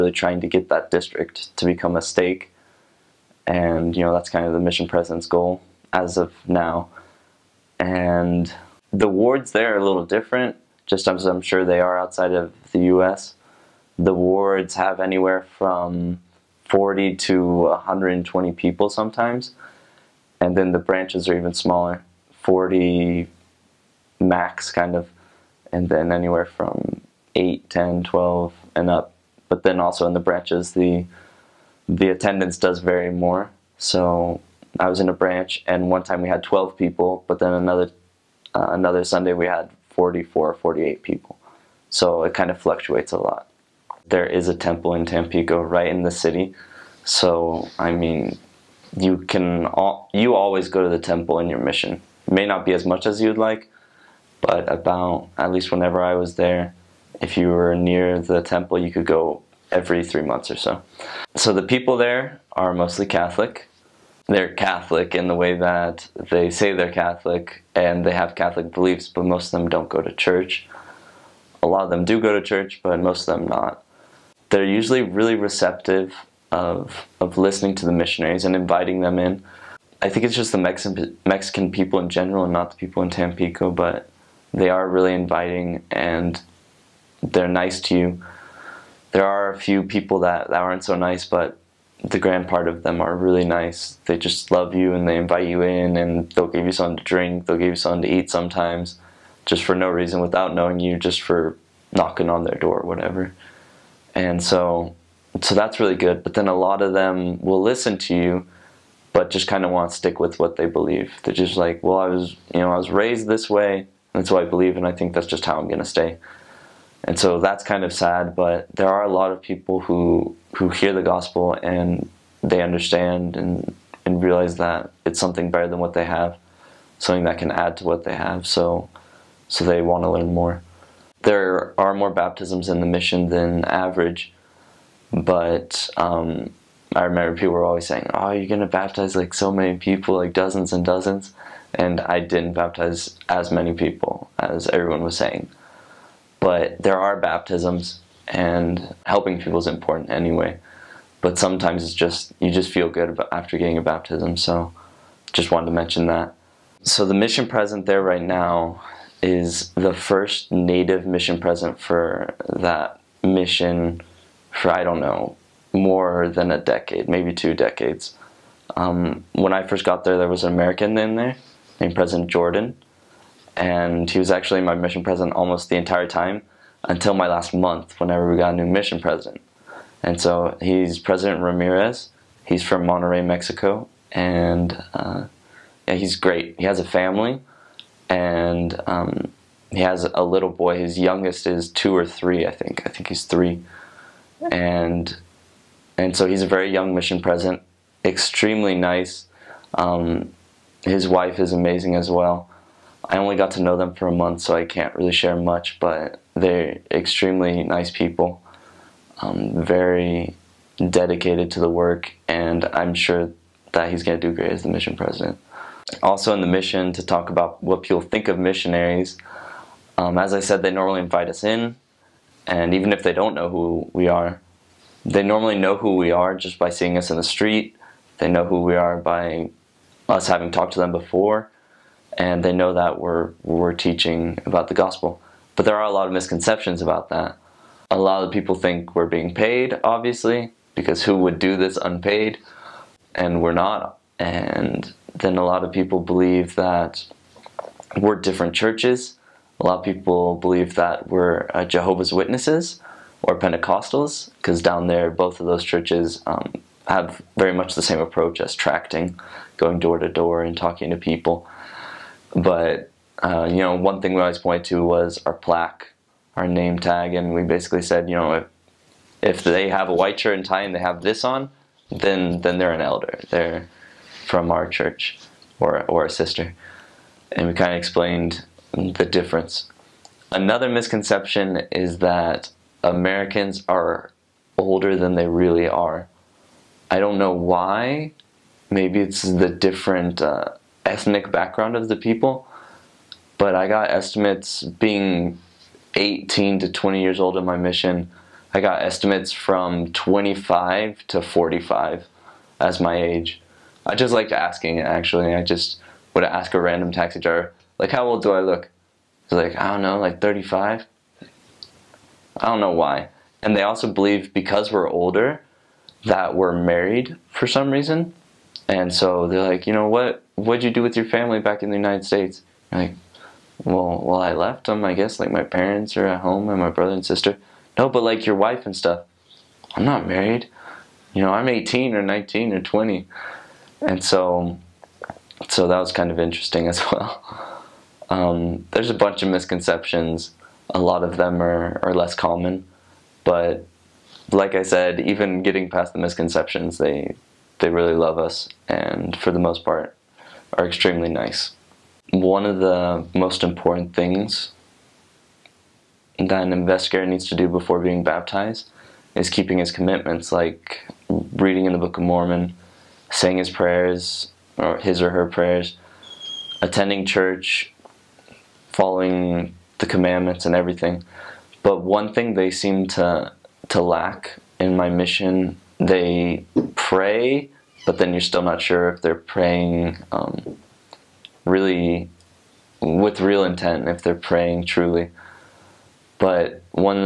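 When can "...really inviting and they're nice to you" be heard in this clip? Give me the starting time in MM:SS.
01:24.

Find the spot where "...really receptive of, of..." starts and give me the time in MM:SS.
01:15.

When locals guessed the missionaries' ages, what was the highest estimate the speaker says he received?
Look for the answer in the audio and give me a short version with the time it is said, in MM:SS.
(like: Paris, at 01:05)
45, at 05:01.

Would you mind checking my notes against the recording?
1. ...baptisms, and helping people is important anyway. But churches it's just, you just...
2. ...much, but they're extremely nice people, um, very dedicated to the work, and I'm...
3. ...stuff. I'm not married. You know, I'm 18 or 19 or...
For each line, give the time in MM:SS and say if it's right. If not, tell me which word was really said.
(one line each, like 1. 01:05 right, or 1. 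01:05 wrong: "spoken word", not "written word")
1. 02:27 wrong: "sometimes", not "churches"
2. 03:25 right
3. 05:28 right.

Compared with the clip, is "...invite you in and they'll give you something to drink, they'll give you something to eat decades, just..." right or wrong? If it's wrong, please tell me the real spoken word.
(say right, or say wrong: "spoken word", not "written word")
wrong: "sometimes", not "decades".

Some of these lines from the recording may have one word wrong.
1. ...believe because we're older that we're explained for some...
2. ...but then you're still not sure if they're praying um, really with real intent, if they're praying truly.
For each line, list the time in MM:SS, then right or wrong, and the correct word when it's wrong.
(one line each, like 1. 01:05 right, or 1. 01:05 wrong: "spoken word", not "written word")
1. 05:13 wrong: "married", not "explained"
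2. 06:17 right.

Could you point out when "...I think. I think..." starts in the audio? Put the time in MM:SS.
03:12.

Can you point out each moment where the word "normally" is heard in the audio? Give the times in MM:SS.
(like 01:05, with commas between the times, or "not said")
03:40, 03:45.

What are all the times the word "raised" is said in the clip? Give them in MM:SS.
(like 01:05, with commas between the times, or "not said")
01:52.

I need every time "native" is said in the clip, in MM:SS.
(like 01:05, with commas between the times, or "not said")
02:40.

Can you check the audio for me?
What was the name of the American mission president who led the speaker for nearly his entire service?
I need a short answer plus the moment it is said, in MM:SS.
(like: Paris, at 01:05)
President Jordan, at 02:51.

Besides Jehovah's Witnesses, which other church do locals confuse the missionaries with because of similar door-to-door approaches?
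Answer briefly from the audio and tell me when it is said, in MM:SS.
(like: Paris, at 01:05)
Pentecostals, at 04:13.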